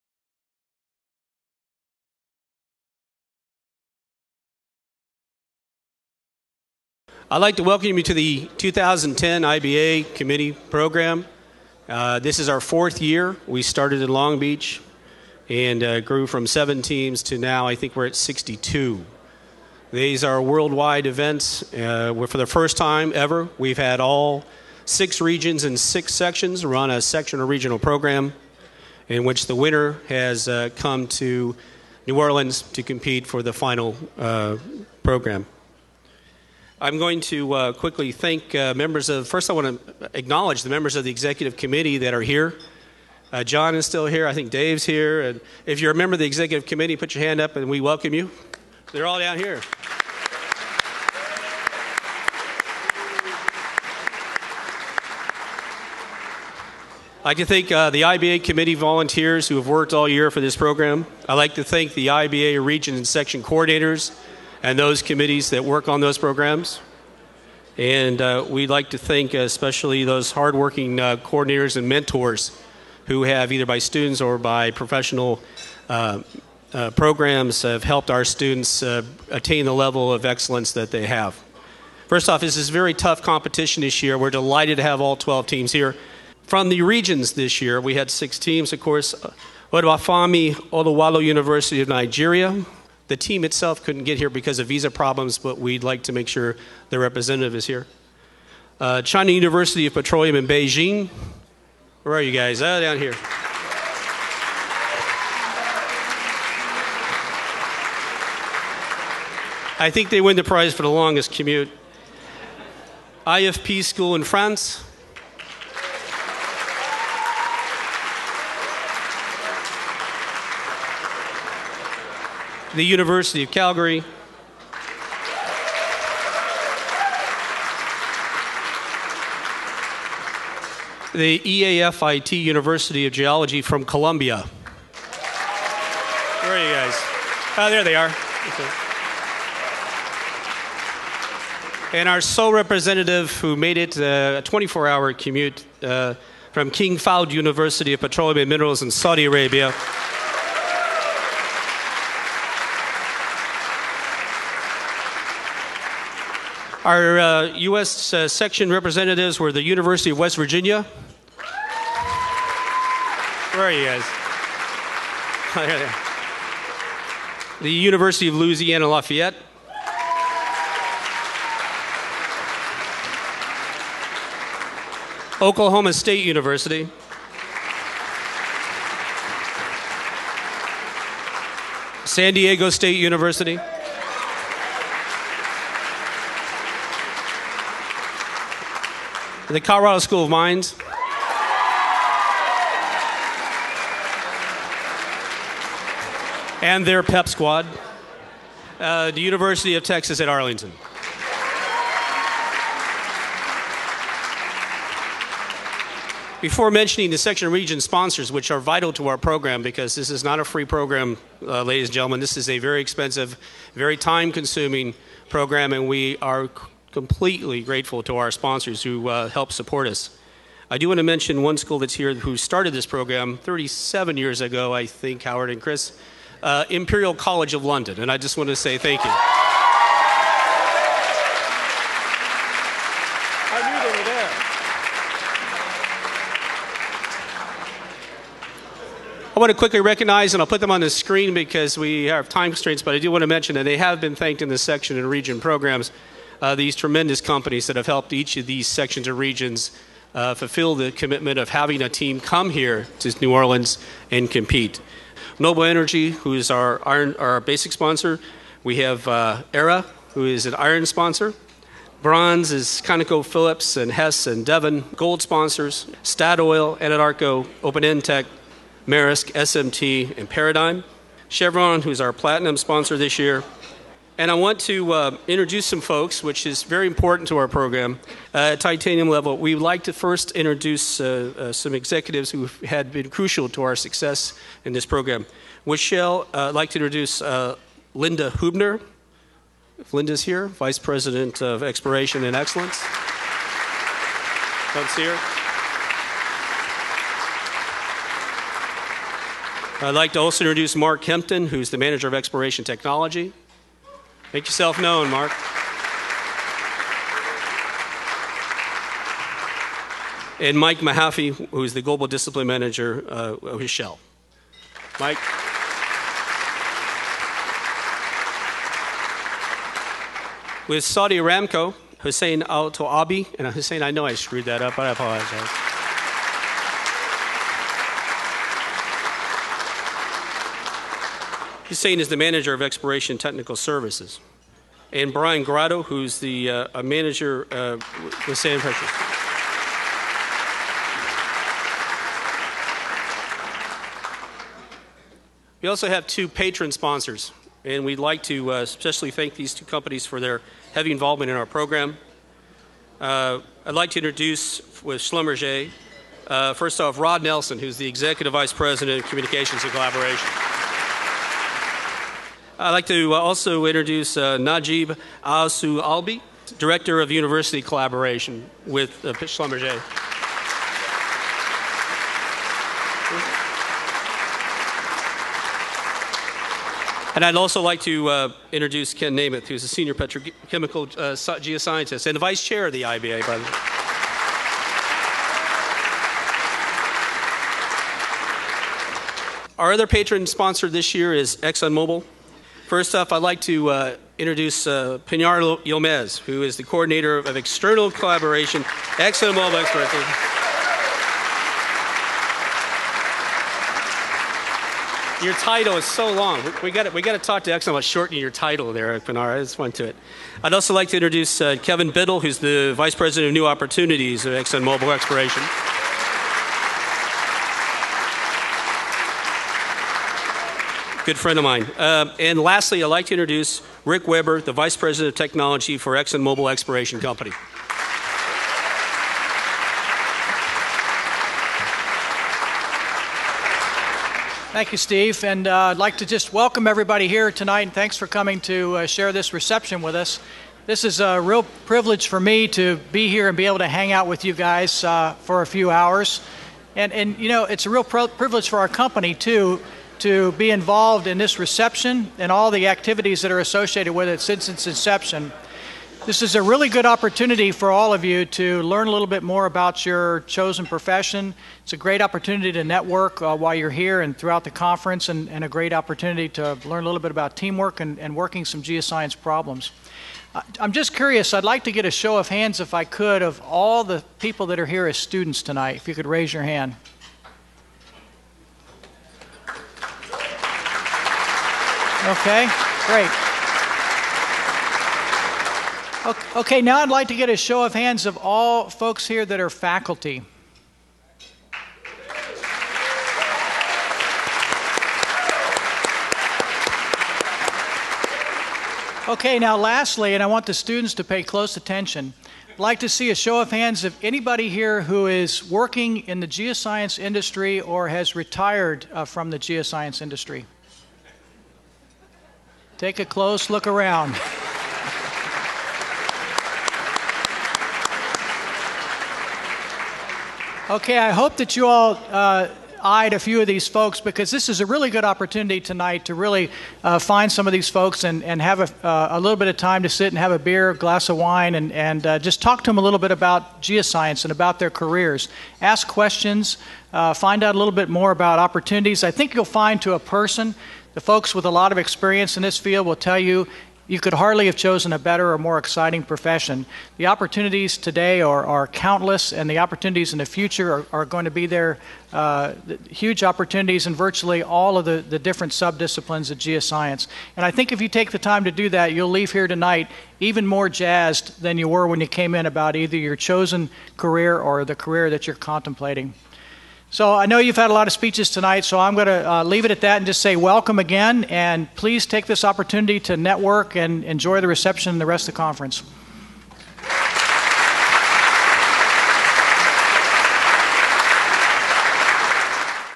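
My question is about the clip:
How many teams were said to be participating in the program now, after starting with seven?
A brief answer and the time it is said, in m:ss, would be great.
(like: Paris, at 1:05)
62, at 0:18.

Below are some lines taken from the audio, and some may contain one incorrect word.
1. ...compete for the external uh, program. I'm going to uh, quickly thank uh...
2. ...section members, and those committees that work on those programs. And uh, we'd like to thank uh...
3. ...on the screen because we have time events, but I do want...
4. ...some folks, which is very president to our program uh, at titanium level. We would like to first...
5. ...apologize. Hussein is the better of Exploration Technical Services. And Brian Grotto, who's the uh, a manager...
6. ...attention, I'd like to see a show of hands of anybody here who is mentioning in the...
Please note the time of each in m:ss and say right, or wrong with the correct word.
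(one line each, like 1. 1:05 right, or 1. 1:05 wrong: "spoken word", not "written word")
1. 0:32 wrong: "final", not "external"
2. 1:03 wrong: "coordinators", not "members"
3. 4:00 wrong: "constraints", not "events"
4. 4:35 wrong: "important", not "president"
5. 5:24 wrong: "manager", not "better"
6. 8:21 wrong: "working", not "mentioning".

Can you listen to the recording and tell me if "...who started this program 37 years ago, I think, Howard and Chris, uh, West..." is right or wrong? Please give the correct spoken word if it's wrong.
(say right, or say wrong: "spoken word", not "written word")
wrong: "Imperial", not "West".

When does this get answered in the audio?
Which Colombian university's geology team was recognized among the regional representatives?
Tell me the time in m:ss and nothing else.
2:11.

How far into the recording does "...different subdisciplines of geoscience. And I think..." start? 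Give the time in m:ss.
9:15.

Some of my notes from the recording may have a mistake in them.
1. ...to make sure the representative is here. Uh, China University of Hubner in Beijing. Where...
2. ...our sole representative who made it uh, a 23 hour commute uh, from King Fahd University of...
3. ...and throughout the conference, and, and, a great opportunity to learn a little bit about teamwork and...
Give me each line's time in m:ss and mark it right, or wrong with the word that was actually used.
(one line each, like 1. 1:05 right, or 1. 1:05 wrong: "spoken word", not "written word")
1. 1:36 wrong: "Petroleum", not "Hubner"
2. 2:22 wrong: "24", not "23"
3. 7:44 right.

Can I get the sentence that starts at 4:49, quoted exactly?
If Linda's here, Vice President of Exploration and Excellence.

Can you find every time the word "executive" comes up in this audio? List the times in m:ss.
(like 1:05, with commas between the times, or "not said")
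0:41, 0:46, 4:41, 5:57.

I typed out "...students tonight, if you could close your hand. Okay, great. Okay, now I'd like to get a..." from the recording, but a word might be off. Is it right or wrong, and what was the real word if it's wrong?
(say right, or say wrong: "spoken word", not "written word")
wrong: "raise", not "close".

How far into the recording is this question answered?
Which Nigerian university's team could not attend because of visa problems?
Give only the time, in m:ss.
1:29.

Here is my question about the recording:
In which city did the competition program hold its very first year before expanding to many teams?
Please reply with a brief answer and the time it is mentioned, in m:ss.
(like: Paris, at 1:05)
Long Beach, at 0:14.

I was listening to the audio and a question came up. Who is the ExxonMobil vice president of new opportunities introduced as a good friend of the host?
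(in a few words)
Kevin Biddle.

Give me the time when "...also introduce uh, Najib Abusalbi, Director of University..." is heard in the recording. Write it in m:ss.
6:03.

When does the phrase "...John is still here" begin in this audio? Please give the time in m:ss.
0:43.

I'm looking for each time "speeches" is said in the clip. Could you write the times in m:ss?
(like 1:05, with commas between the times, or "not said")
9:27.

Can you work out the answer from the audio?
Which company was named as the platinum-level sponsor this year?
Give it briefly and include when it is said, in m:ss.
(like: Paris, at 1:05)
Chevron, at 4:31.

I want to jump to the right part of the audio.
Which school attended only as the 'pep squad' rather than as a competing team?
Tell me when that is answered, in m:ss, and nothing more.
3:19.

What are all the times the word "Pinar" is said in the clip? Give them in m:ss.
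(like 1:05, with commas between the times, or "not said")
6:35, 6:49.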